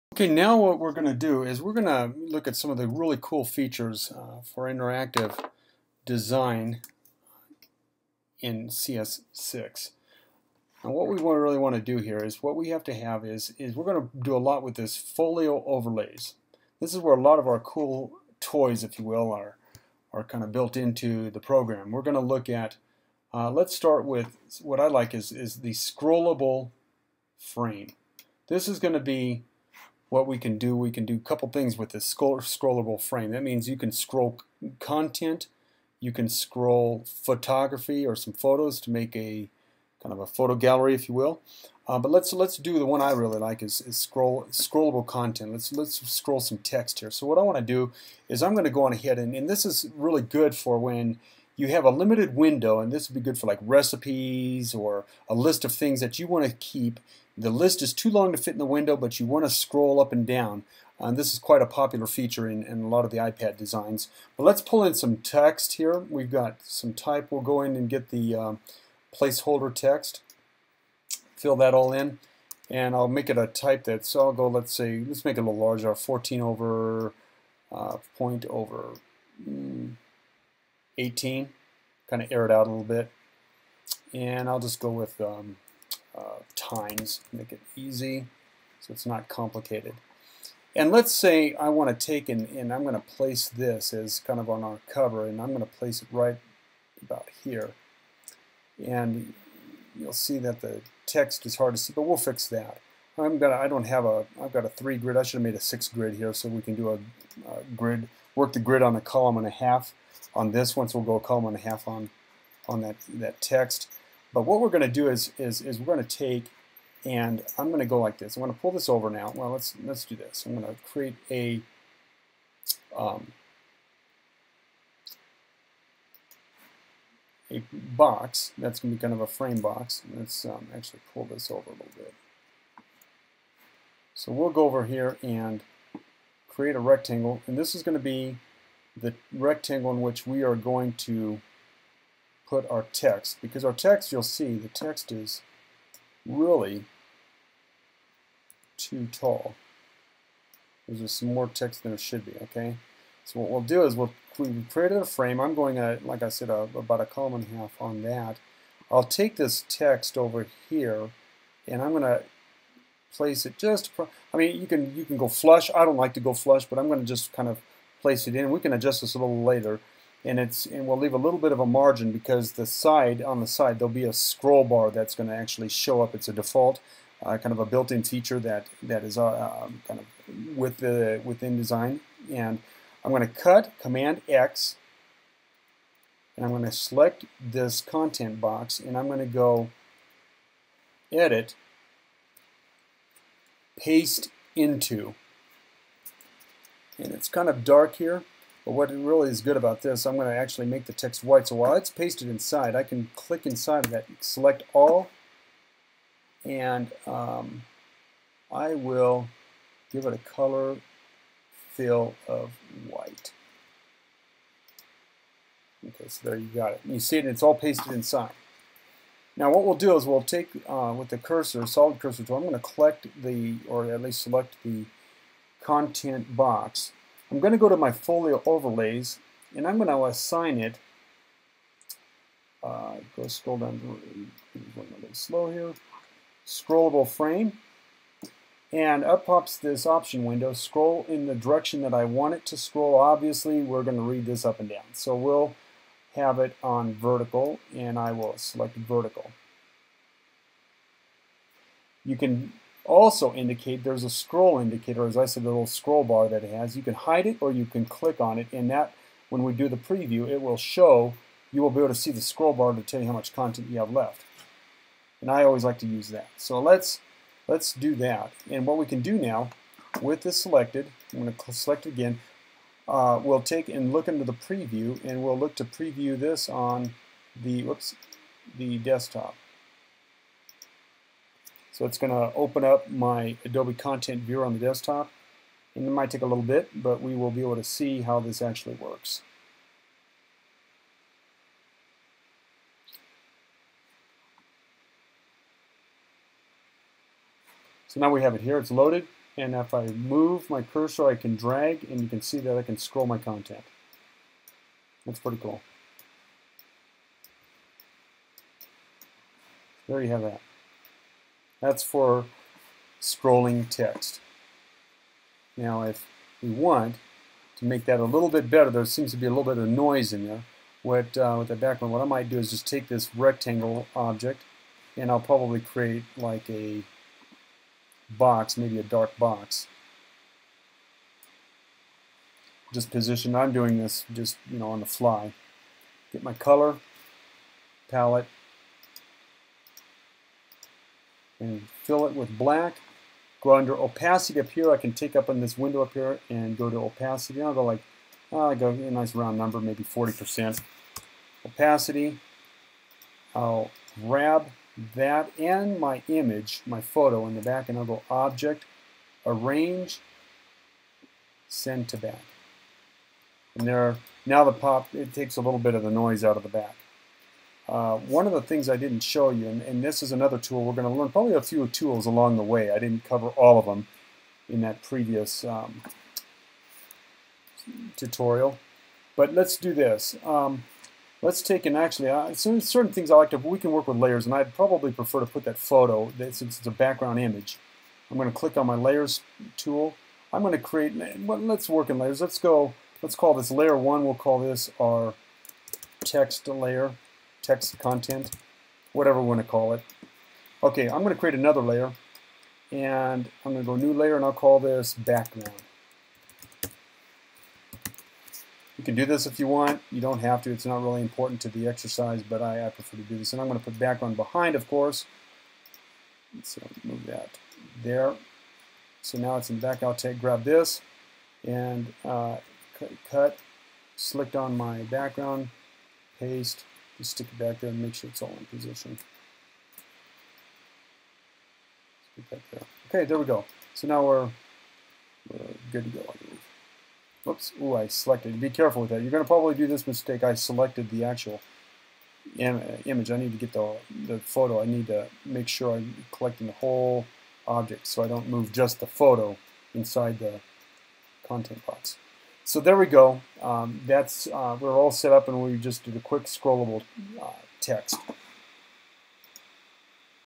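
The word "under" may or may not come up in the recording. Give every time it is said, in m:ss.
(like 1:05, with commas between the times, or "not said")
5:43.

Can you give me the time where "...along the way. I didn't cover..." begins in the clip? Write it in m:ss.
6:12.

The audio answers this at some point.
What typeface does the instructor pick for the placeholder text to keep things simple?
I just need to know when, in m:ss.
1:26.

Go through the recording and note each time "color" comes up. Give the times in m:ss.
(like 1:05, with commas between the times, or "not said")
3:30, 5:36.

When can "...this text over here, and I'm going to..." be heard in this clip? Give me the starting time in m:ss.
2:39.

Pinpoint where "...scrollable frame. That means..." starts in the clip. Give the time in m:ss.
0:32.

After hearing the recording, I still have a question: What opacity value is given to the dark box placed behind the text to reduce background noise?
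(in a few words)
40%.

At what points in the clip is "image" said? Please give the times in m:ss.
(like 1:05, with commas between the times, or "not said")
5:56, 6:27, 7:22.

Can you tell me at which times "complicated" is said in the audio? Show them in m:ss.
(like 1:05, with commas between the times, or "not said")
1:29.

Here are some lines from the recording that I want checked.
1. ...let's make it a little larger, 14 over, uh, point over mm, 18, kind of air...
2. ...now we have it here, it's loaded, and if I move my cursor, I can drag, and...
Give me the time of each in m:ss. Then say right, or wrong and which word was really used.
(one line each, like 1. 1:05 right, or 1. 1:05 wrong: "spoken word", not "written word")
1. 1:15 right
2. 4:57 right.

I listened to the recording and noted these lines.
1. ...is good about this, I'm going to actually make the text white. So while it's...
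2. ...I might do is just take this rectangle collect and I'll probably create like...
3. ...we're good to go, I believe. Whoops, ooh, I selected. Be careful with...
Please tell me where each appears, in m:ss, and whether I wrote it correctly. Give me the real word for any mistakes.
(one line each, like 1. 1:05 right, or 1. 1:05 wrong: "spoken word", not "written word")
1. 3:19 right
2. 5:22 wrong: "object", not "collect"
3. 7:15 right.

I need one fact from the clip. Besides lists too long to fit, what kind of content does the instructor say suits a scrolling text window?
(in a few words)
Recipes.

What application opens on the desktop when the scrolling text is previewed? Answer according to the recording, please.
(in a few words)
Adobe Content Viewer.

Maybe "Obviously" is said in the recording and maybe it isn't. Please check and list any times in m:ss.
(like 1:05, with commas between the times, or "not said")
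4:02.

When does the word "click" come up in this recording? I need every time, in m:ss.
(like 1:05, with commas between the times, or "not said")
3:23, 4:17, 6:28.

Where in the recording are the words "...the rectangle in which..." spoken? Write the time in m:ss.
2:18.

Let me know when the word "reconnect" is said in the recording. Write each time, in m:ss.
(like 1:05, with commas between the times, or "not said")
not said.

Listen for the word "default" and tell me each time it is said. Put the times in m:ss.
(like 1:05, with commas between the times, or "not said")
2:56.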